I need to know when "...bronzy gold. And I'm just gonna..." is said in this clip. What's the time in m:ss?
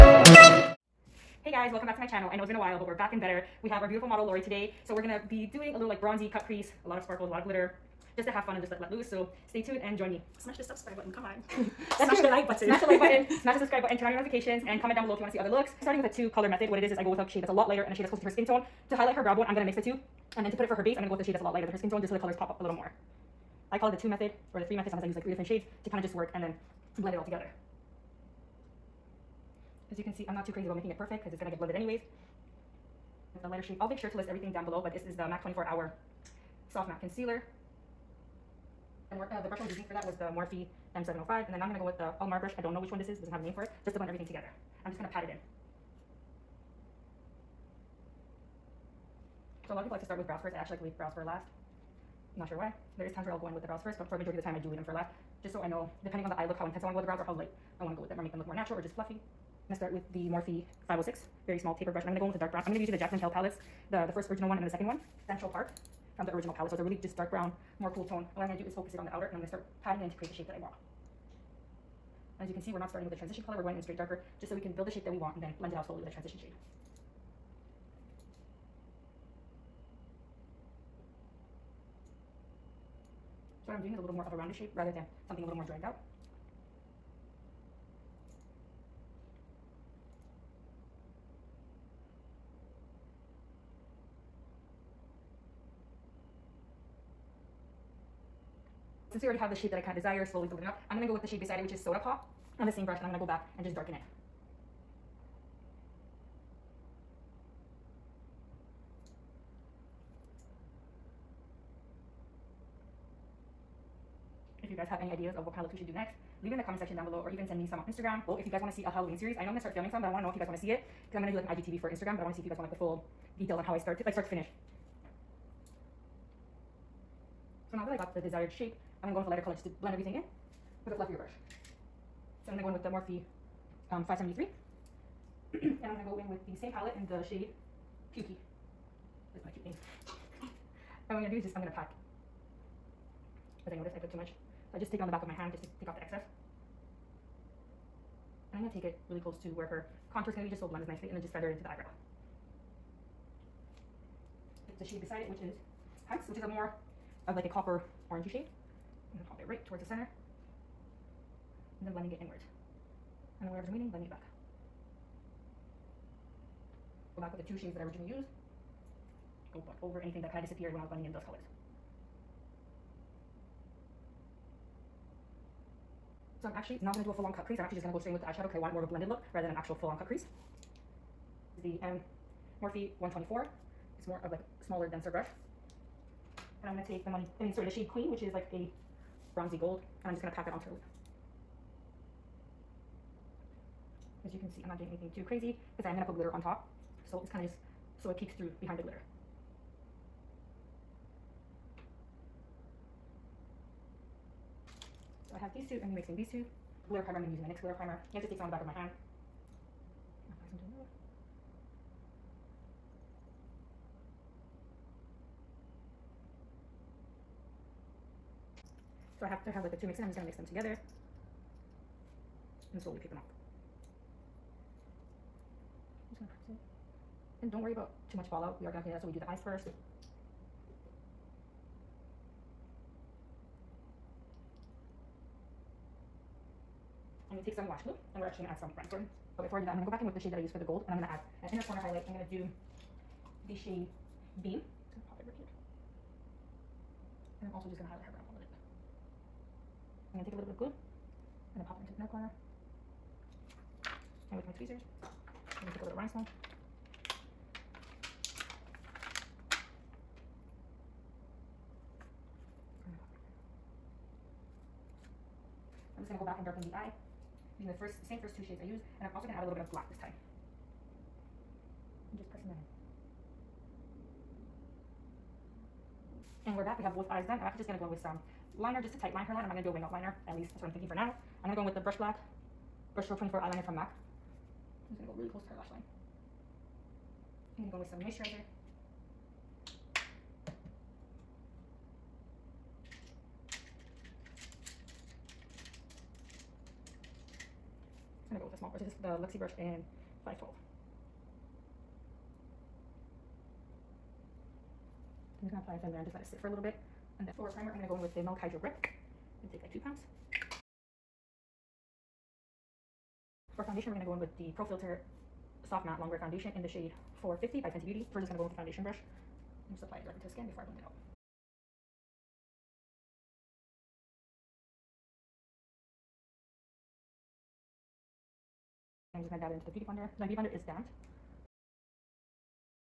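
3:09.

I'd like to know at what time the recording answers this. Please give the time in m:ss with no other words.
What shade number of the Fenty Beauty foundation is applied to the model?
5:17.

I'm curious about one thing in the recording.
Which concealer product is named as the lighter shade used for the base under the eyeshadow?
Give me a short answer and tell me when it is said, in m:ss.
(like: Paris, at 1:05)
MAC 24 Hour Soft Matte Concealer, at 0:35.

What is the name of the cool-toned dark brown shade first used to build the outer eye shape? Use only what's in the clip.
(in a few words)
Central Park.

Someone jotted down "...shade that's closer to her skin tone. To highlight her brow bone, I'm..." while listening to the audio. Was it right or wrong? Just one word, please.
right.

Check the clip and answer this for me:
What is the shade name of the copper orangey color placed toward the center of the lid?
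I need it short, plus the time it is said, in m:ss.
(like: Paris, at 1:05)
Hunty, at 2:36.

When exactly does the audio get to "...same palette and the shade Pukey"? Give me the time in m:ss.
2:16.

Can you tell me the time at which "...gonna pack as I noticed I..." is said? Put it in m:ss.
2:21.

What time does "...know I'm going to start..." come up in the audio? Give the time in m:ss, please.
1:59.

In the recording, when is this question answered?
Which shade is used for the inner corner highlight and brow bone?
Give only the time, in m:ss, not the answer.
4:04.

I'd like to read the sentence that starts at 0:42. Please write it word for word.
I don't know which one this is, it doesn't have a name for it, just to blend everything together.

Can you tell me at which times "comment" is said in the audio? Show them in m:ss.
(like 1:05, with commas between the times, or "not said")
0:14, 1:56.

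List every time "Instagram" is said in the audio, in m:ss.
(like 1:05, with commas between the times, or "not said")
1:57, 2:01.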